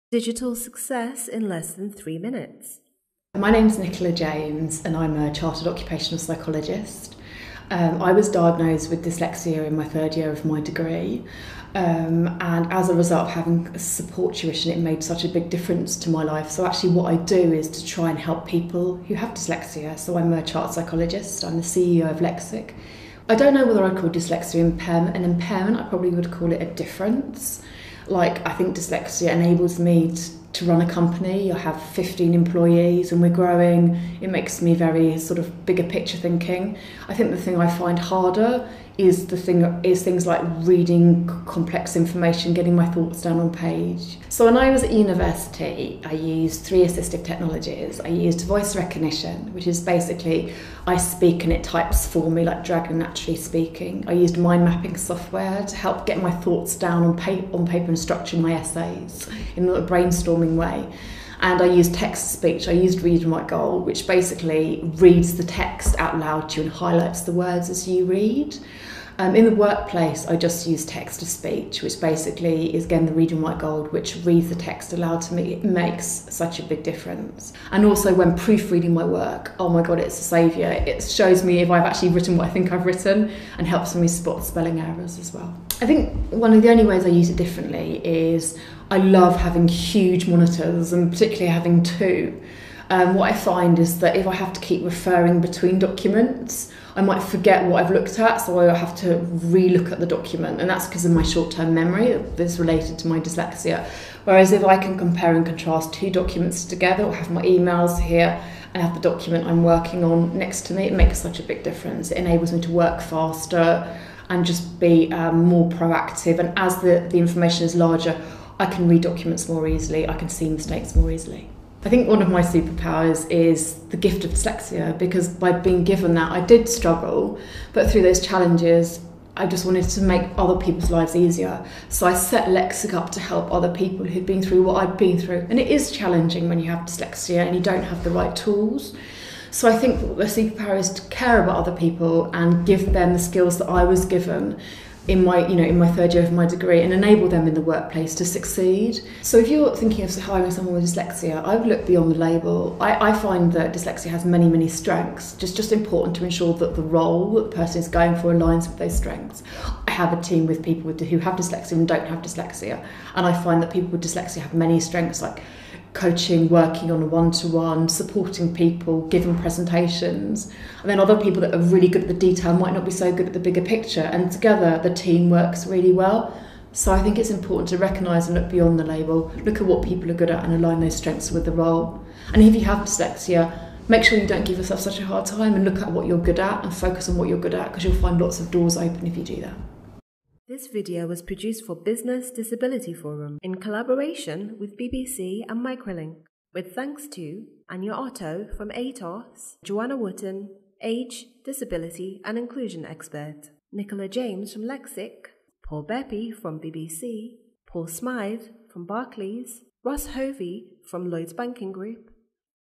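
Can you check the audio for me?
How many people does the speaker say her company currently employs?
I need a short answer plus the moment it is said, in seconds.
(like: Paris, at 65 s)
15, at 31 s.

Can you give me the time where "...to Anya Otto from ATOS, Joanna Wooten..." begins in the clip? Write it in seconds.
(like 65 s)
197 s.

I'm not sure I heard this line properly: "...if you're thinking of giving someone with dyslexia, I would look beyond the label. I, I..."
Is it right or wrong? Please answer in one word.
wrong.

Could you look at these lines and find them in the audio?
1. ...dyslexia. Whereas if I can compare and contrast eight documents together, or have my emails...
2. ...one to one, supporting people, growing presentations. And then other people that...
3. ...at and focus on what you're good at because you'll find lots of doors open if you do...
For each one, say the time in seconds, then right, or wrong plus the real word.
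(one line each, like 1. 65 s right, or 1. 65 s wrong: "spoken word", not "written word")
1. 103 s wrong: "two", not "eight"
2. 167 s wrong: "giving", not "growing"
3. 186 s right.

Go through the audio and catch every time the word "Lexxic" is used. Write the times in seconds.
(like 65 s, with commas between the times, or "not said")
22 s, 132 s, 204 s.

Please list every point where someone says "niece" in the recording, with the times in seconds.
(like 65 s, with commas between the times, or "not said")
not said.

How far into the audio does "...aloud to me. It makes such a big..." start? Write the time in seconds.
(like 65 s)
74 s.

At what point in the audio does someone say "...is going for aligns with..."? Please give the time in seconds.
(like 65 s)
157 s.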